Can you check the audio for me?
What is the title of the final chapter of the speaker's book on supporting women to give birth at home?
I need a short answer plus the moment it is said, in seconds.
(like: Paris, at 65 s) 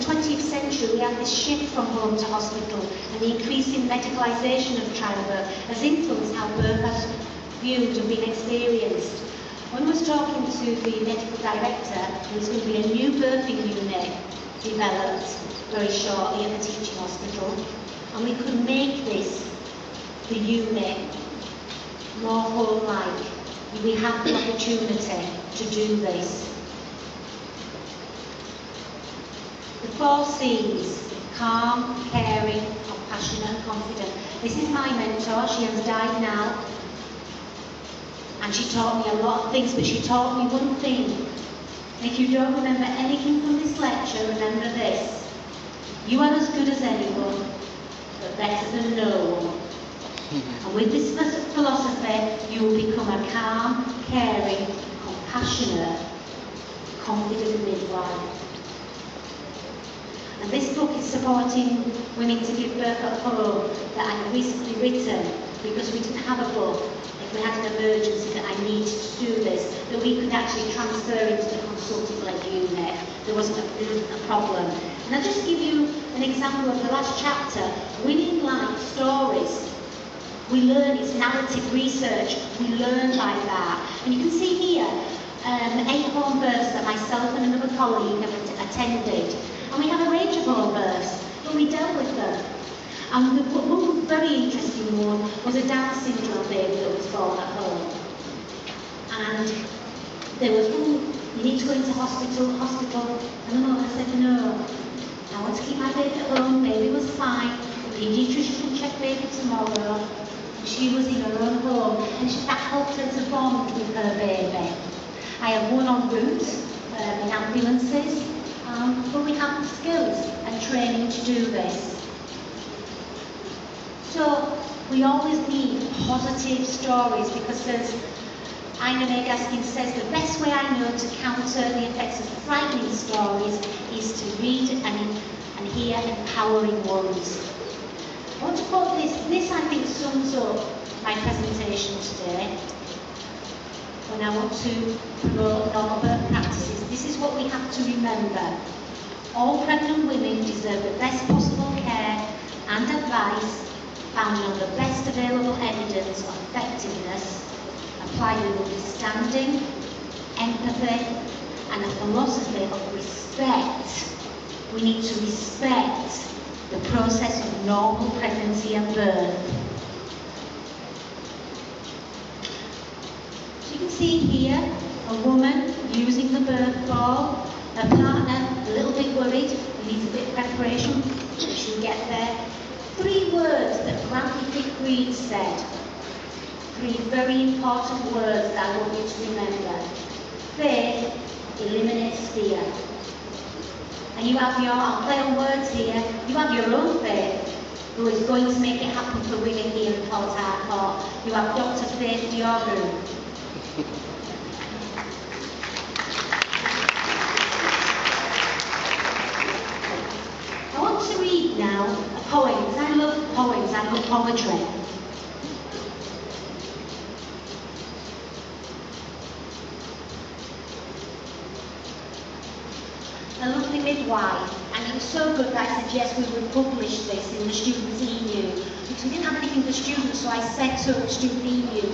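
Winning Life Stories, at 78 s.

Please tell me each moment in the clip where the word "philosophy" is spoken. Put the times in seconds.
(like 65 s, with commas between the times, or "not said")
51 s, 161 s.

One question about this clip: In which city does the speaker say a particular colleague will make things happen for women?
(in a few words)
Port Harcourt.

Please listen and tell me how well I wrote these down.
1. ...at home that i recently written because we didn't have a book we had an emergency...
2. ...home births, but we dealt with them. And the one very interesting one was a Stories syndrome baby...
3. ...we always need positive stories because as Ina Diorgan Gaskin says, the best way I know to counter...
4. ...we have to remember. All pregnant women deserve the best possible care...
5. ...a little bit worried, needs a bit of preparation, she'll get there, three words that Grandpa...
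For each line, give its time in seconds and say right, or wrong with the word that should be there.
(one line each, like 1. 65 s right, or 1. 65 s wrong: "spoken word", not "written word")
1. 63 s right
2. 90 s wrong: "Down", not "Stories"
3. 124 s wrong: "May", not "Diorgan"
4. 147 s right
5. 178 s right.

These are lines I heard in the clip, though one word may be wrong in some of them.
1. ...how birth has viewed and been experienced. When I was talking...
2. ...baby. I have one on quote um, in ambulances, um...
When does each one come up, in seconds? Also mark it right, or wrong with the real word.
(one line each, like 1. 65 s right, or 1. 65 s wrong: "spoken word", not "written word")
1. 6 s right
2. 114 s wrong: "route", not "quote".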